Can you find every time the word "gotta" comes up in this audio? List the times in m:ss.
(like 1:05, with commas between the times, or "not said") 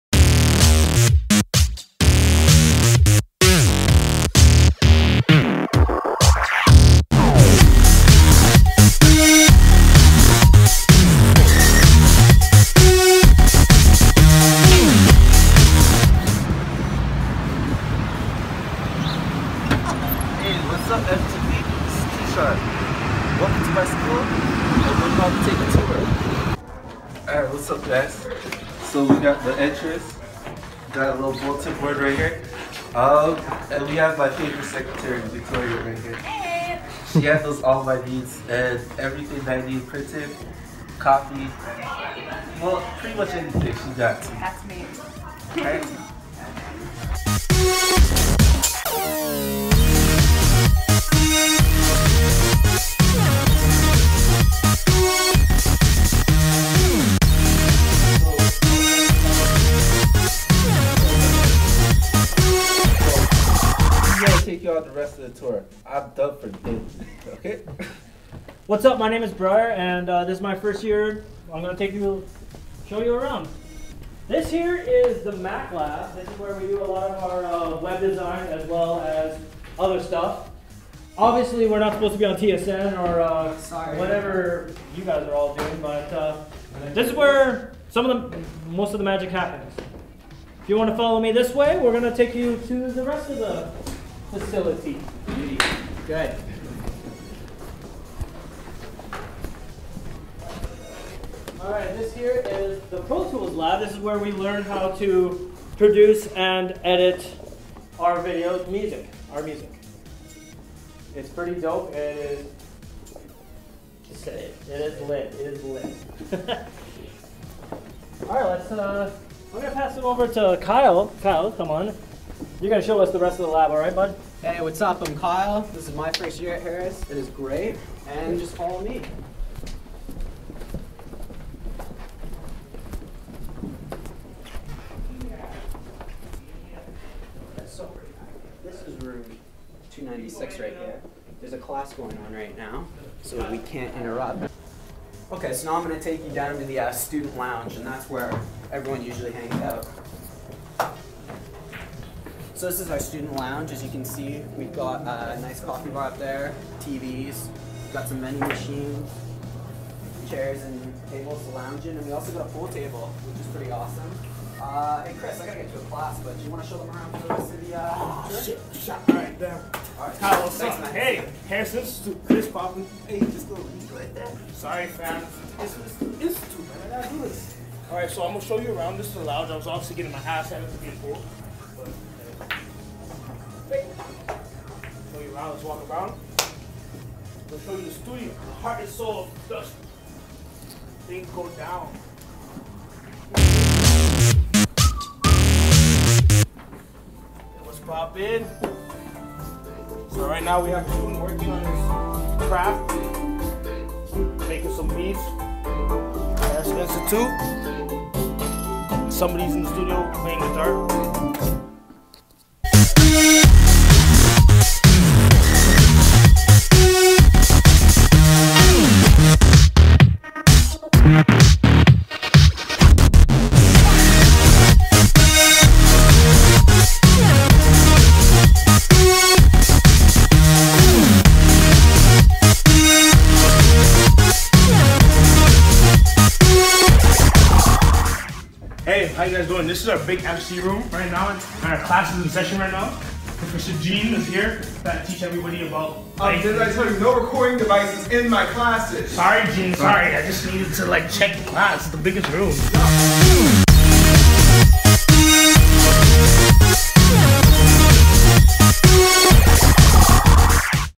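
2:45, 2:57.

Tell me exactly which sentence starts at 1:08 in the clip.
My name is Bryer, and uh, this is my first year.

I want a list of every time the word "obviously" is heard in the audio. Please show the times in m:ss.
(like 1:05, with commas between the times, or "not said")
1:21, 2:59.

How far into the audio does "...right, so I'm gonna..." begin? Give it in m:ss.
2:57.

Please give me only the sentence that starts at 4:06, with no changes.
Uh, did I tell you no recording devices in my classes?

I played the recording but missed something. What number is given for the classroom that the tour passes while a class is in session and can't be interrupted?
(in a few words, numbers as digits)
296.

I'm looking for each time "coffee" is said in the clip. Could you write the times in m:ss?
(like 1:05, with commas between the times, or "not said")
0:40, 2:35.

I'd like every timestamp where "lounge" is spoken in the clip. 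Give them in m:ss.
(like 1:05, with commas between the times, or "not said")
2:27, 2:33, 2:41, 2:59.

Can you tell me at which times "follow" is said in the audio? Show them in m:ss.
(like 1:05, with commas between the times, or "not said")
1:30, 2:08.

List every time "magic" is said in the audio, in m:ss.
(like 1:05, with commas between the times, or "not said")
1:29.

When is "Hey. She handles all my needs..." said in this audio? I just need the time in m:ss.
0:36.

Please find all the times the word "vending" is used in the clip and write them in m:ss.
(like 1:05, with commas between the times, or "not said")
2:38.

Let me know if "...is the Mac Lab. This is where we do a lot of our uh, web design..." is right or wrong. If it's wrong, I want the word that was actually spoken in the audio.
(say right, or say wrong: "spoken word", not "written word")
right.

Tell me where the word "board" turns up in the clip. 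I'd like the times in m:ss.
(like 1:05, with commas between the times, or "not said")
0:31.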